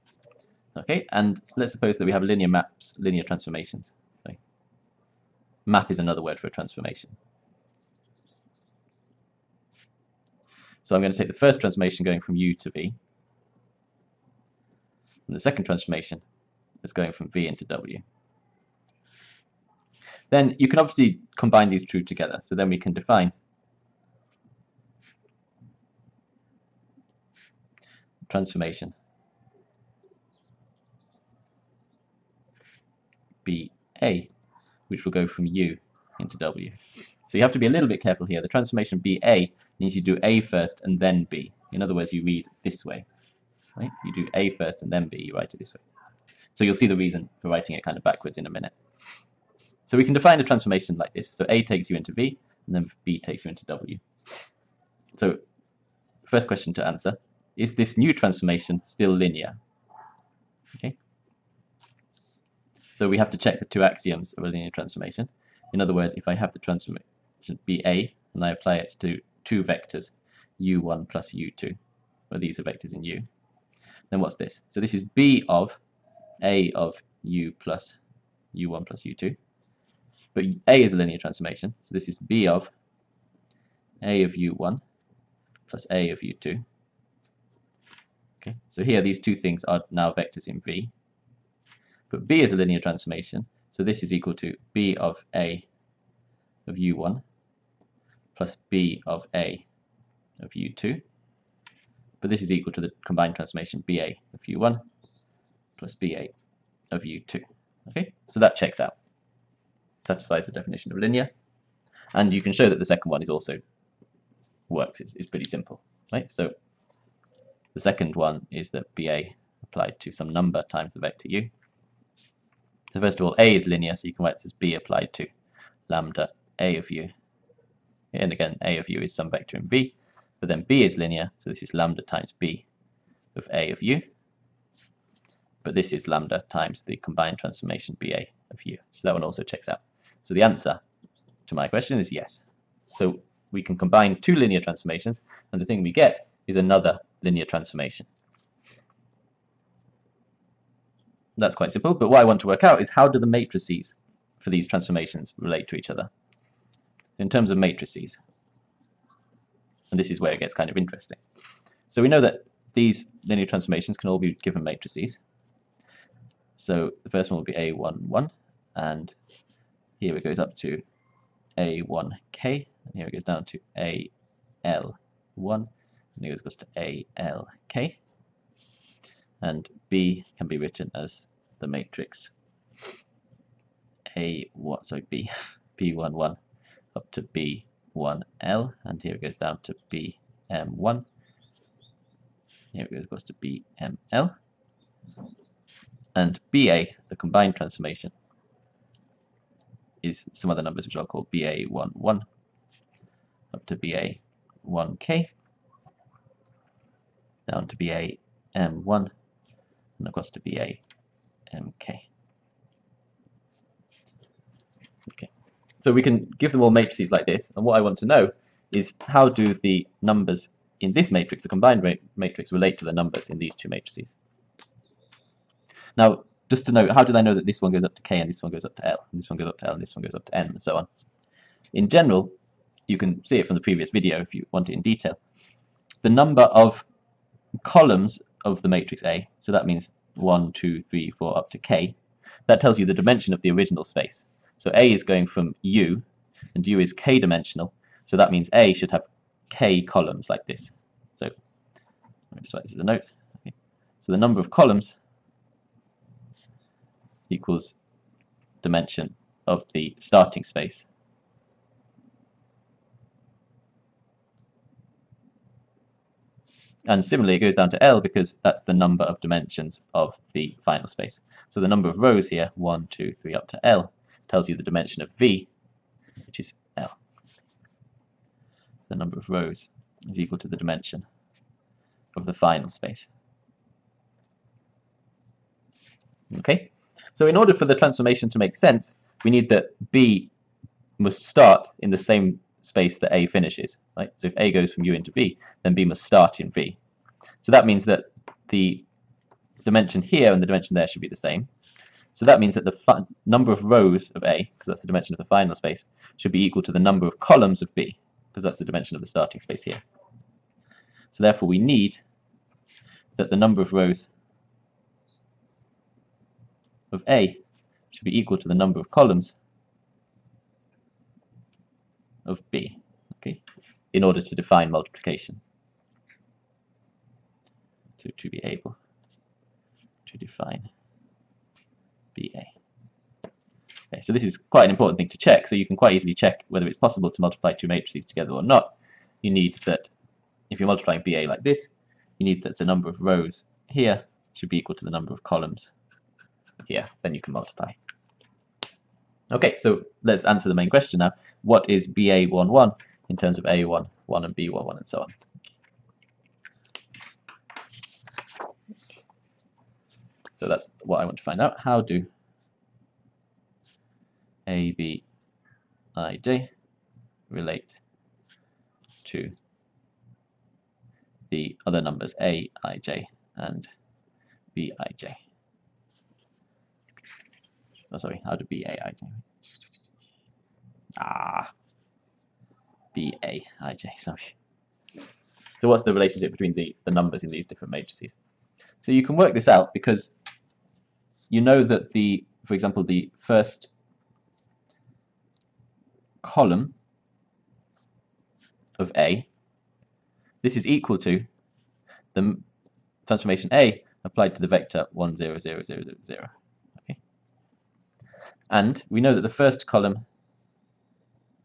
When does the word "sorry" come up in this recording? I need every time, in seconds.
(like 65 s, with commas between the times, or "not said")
4 s, 184 s, 377 s, 383 s.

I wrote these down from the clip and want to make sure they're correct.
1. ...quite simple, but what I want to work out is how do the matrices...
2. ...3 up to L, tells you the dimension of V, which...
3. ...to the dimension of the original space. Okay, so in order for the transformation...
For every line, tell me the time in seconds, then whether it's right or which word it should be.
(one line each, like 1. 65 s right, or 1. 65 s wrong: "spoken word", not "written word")
1. 151 s right
2. 273 s right
3. 280 s wrong: "final", not "original".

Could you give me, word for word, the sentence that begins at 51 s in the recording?
So A takes you into V, and then B takes you into W.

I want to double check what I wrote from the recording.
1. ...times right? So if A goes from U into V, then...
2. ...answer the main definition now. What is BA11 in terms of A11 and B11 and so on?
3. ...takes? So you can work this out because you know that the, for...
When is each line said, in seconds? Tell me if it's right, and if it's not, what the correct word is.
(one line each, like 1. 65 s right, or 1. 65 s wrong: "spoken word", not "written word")
1. 293 s wrong: "finishes", not "times"
2. 350 s wrong: "question", not "definition"
3. 387 s wrong: "matrices", not "takes".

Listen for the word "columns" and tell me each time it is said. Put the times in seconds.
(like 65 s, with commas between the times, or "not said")
237 s, 249 s, 254 s, 307 s, 318 s, 345 s, 396 s, 409 s.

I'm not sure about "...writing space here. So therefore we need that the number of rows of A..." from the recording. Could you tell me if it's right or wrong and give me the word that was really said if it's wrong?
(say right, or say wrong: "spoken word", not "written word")
wrong: "starting", not "writing".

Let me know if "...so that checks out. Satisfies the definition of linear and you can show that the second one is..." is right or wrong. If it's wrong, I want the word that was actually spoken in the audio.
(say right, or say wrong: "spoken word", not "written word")
right.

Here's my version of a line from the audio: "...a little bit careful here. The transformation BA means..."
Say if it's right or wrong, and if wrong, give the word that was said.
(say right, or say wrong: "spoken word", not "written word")
right.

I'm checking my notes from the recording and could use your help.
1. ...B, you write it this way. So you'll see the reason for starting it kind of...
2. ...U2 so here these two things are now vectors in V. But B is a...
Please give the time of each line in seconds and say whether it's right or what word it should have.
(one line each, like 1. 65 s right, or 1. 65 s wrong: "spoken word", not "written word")
1. 45 s wrong: "writing", not "starting"
2. 86 s right.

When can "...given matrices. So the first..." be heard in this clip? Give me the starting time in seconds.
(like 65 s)
164 s.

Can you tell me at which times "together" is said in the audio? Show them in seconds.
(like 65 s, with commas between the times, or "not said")
22 s, 338 s.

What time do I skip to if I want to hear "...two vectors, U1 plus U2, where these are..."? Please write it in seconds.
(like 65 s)
69 s.